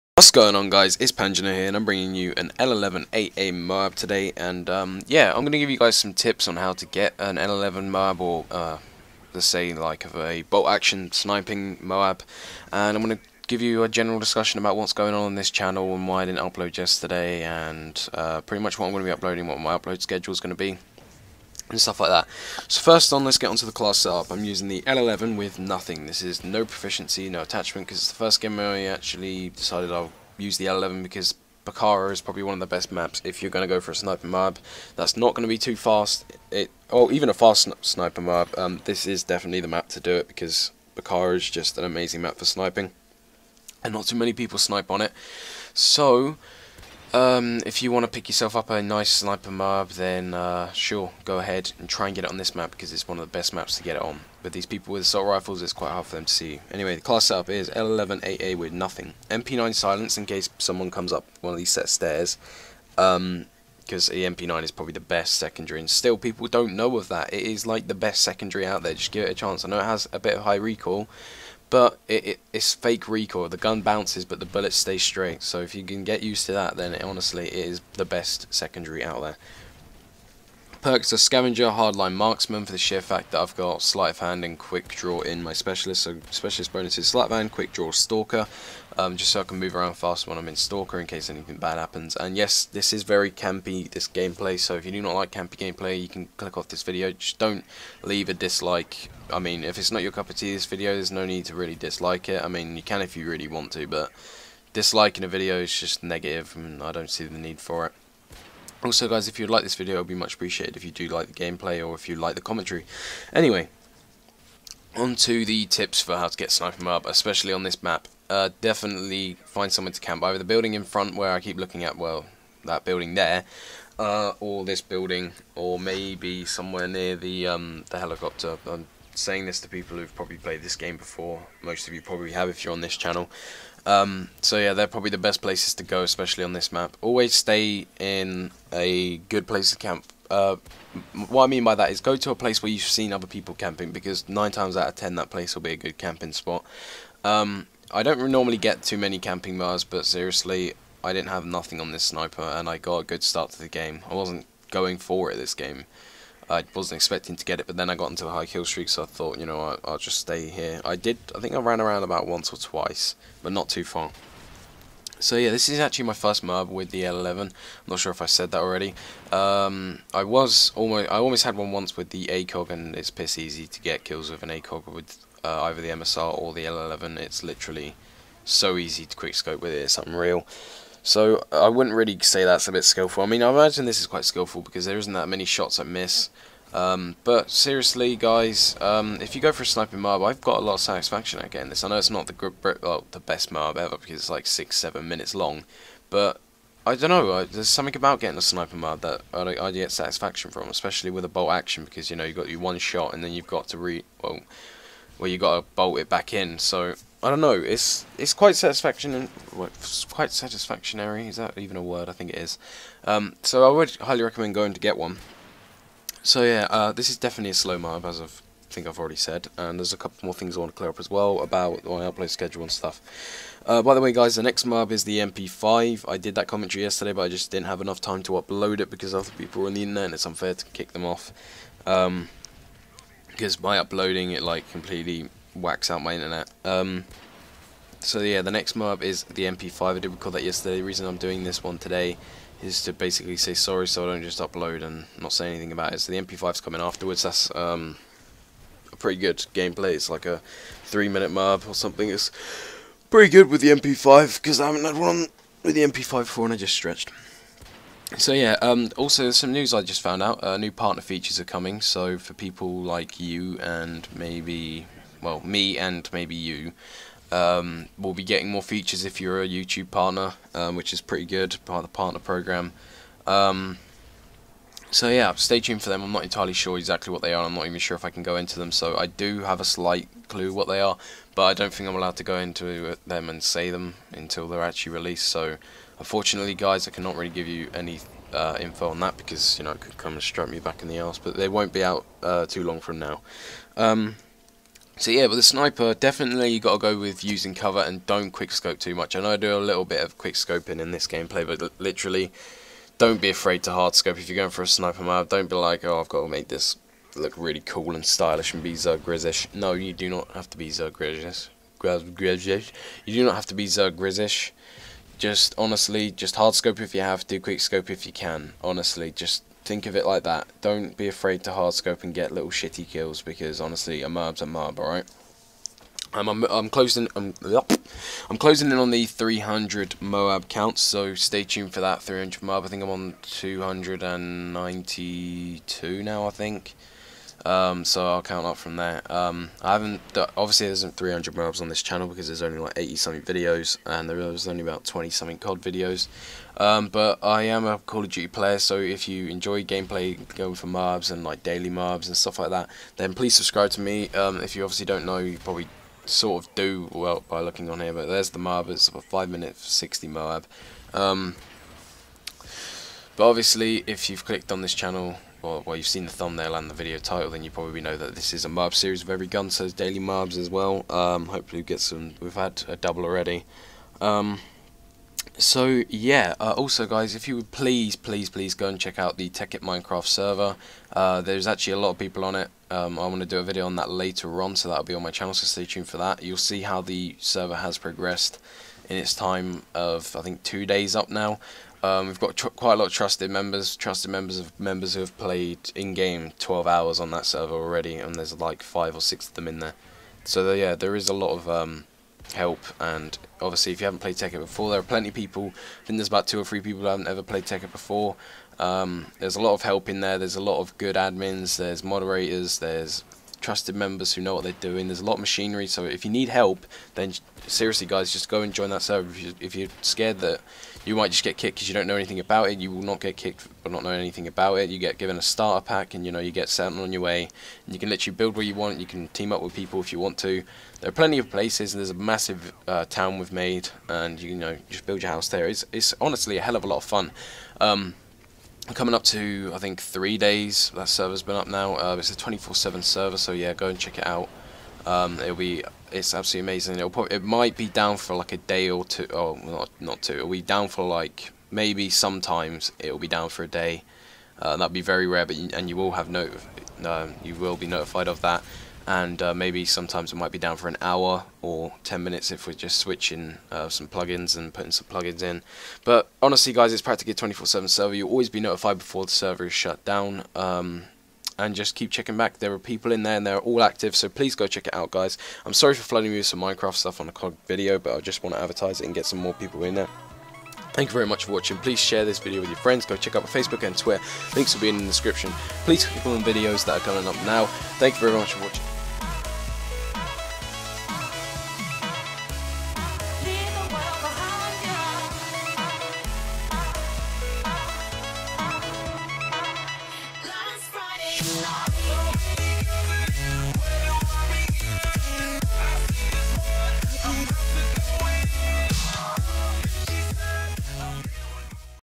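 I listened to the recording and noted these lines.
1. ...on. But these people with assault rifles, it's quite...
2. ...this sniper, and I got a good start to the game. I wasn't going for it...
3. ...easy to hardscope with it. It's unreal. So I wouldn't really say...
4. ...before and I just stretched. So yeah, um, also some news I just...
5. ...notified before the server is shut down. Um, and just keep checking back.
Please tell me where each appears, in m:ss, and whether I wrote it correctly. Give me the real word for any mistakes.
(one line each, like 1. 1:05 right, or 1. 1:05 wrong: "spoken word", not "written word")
1. 0:54 right
2. 2:31 right
3. 2:58 wrong: "quickscope", not "hardscope"
4. 4:16 right
5. 7:48 right.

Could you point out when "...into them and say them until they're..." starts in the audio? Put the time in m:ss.
4:42.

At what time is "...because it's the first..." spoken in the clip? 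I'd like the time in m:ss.
0:27.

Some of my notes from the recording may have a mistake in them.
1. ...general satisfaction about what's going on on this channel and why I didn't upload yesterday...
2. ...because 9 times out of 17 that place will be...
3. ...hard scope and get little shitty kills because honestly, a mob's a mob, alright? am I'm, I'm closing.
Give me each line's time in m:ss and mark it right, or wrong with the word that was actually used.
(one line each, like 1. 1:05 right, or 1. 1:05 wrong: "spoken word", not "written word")
1. 0:13 wrong: "discussion", not "satisfaction"
2. 2:23 wrong: "10", not "17"
3. 5:21 right.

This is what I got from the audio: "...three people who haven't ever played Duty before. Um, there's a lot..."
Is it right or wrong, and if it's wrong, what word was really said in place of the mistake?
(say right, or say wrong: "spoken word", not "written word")
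wrong: "Tekkit", not "Duty".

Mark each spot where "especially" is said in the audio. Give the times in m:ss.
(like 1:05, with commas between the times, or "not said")
1:57, 2:16, 3:20.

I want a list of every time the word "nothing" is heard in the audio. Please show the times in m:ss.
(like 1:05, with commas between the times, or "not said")
0:25, 0:58, 2:31.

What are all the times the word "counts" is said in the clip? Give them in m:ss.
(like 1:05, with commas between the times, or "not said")
5:30, 5:38.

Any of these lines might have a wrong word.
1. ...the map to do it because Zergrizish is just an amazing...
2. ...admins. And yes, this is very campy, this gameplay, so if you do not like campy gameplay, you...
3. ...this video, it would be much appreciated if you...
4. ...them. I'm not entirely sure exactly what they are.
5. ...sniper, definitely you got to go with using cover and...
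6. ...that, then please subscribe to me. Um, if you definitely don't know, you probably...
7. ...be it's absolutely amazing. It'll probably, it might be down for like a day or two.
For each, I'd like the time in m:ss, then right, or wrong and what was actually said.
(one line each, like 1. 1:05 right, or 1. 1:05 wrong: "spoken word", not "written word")
1. 0:39 wrong: "Bakaara", not "Zergrizish"
2. 1:31 wrong: "happens", not "admins"
3. 1:49 right
4. 4:35 right
5. 4:55 right
6. 5:52 wrong: "obviously", not "definitely"
7. 7:25 right.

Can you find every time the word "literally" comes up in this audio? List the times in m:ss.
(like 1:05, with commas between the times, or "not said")
2:57, 5:01, 7:07.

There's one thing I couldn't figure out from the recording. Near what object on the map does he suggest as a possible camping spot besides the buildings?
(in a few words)
the helicopter.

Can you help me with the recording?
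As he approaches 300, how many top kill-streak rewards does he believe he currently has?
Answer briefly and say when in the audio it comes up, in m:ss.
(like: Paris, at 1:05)
292, at 5:33.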